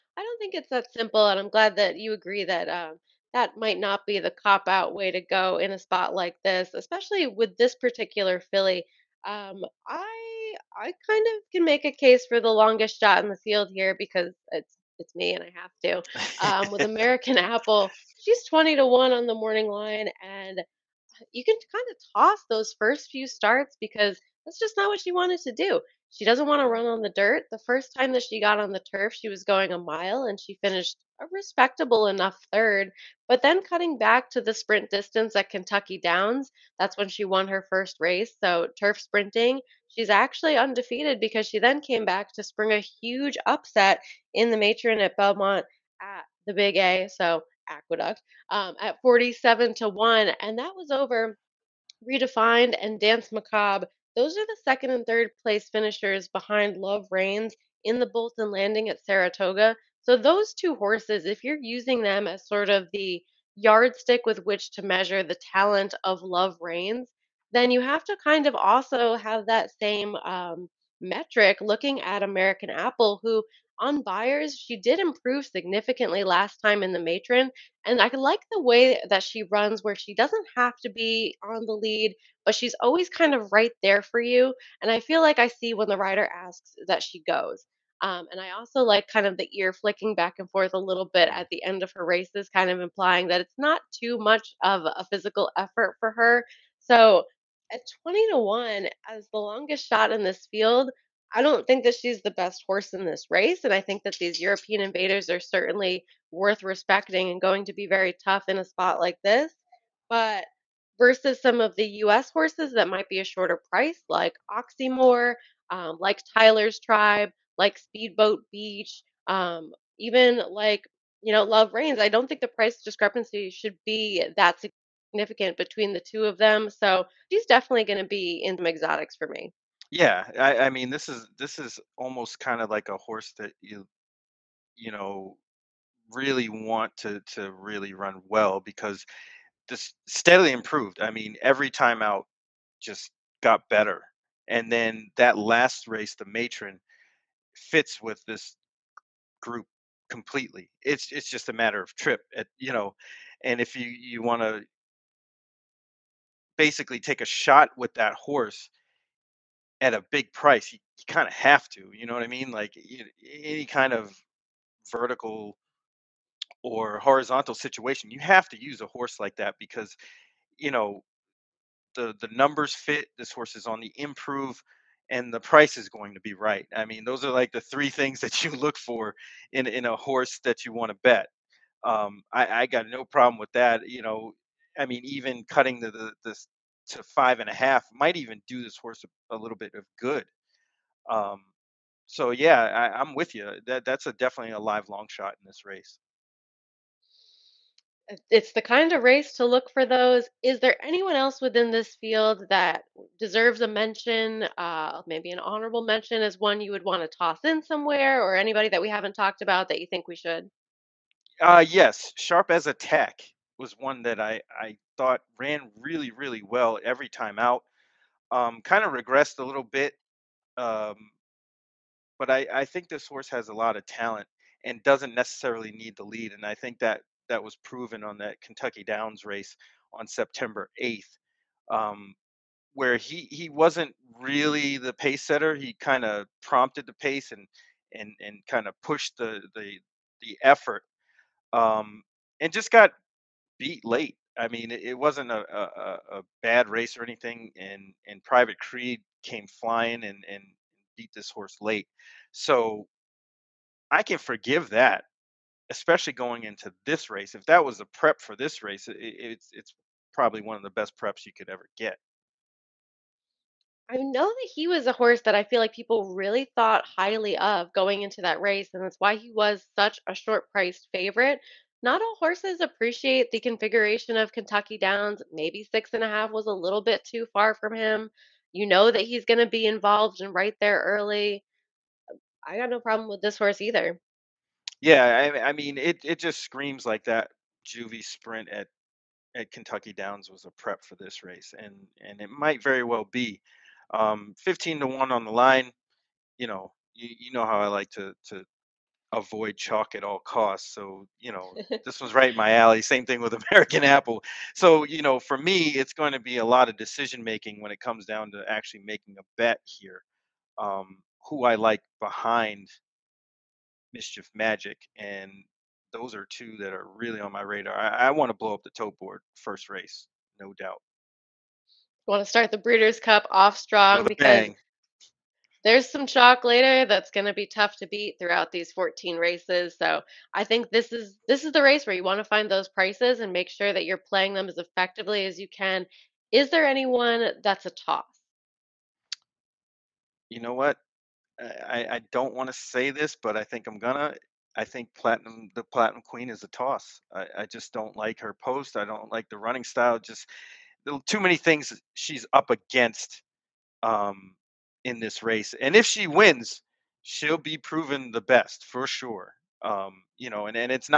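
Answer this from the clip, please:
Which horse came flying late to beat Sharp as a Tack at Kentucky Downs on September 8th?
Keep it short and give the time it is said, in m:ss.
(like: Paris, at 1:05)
Private Creed, at 4:08.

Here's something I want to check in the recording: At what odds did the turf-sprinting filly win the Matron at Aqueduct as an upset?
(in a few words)
47 to 1.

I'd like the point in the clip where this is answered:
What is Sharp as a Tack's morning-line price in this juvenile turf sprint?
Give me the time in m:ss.
4:54.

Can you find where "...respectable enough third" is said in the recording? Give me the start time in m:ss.
0:31.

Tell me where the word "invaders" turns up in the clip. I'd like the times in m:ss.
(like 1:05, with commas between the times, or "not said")
1:44.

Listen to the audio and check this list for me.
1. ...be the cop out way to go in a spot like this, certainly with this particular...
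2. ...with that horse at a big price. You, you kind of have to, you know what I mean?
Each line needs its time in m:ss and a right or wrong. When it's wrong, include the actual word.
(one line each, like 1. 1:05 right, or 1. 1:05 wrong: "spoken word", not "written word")
1. 0:04 wrong: "especially", not "certainly"
2. 2:37 right.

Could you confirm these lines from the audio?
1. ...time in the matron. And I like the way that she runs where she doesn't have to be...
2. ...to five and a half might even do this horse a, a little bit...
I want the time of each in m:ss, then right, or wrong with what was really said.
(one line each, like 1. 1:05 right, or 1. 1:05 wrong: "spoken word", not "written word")
1. 1:16 right
2. 3:06 right.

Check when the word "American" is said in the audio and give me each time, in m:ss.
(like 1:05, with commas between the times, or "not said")
0:16, 1:12, 5:03.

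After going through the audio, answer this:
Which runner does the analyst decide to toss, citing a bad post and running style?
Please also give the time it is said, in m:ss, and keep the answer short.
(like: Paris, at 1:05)
The Platinum Queen, at 5:45.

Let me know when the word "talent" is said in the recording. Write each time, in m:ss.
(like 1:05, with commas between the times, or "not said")
1:05, 3:43.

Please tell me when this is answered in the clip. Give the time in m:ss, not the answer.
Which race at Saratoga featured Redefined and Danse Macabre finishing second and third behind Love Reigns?
0:58.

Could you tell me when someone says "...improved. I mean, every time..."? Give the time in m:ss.
2:20.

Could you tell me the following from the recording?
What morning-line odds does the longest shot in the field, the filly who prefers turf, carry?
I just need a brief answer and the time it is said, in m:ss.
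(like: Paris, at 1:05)
20 to 1, at 0:18.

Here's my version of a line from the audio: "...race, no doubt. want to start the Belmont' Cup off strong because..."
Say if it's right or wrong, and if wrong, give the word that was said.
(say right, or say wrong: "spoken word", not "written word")
wrong: "Breeders", not "Belmont".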